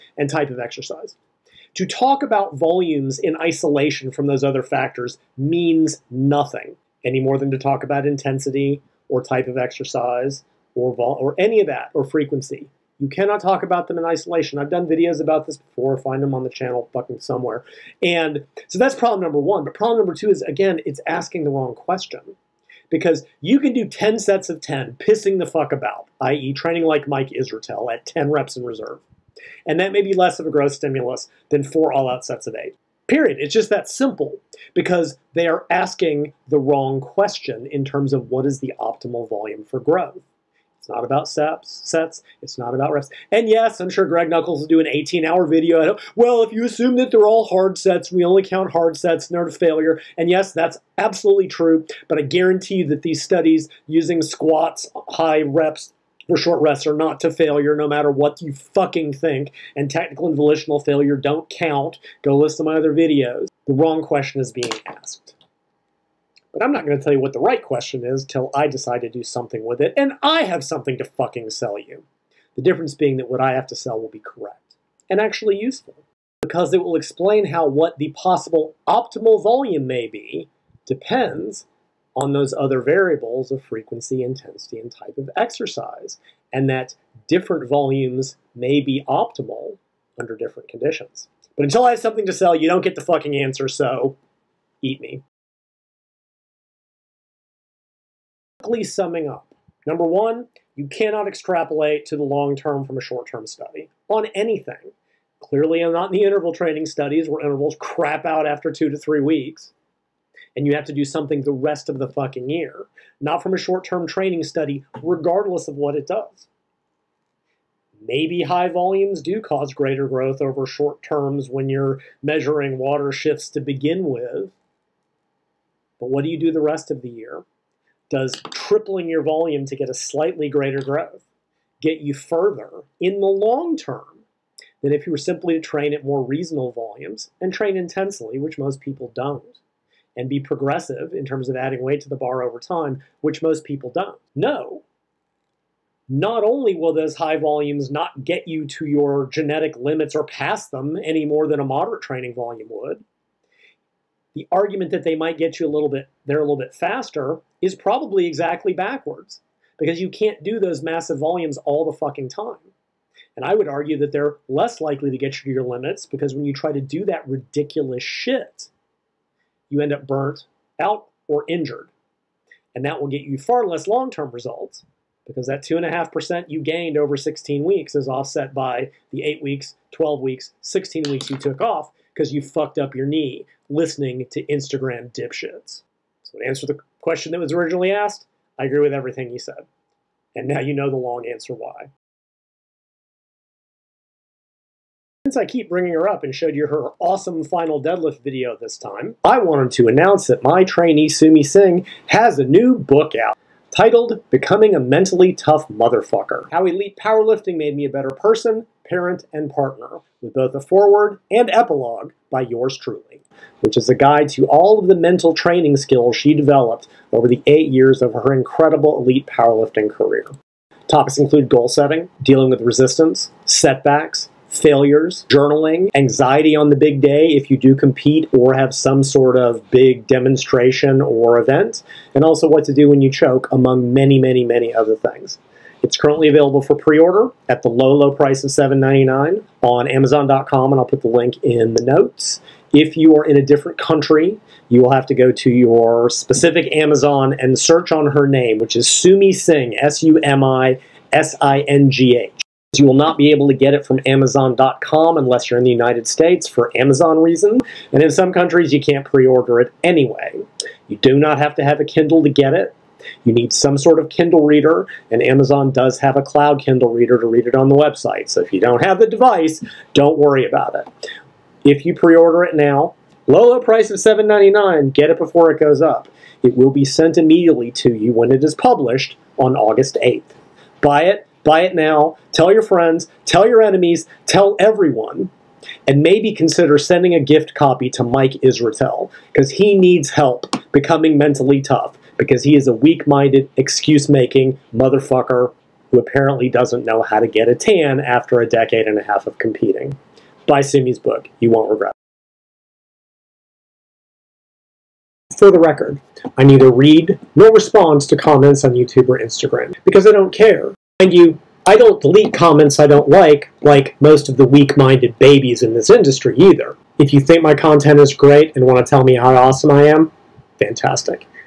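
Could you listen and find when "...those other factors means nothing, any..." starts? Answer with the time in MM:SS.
00:04.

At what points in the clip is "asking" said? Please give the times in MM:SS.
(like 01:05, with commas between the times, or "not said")
00:21, 00:35.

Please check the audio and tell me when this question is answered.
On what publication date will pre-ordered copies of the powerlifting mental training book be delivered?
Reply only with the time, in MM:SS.
04:39.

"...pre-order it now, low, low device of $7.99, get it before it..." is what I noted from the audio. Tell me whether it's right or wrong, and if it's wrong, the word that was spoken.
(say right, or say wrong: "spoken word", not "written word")
wrong: "price", not "device".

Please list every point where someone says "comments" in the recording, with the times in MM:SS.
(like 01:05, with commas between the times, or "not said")
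05:08, 05:12.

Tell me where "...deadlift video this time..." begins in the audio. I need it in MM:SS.
03:17.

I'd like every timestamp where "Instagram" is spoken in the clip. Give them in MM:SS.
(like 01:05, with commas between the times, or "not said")
03:04, 05:09.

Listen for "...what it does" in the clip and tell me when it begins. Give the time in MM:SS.
01:55.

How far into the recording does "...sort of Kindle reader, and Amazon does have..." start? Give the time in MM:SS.
04:23.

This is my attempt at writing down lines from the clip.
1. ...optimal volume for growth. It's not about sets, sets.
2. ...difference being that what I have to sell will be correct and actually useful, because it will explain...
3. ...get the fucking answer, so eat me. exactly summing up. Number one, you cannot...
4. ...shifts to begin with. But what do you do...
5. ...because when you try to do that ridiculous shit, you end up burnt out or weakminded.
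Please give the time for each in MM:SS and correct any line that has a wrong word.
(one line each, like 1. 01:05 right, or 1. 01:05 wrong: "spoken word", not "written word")
1. 00:38 right
2. 01:12 right
3. 01:32 wrong: "quickly", not "exactly"
4. 02:03 right
5. 02:46 wrong: "injured", not "weakminded".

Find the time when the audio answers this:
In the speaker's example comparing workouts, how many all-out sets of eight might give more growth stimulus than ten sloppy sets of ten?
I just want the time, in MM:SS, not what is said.
00:31.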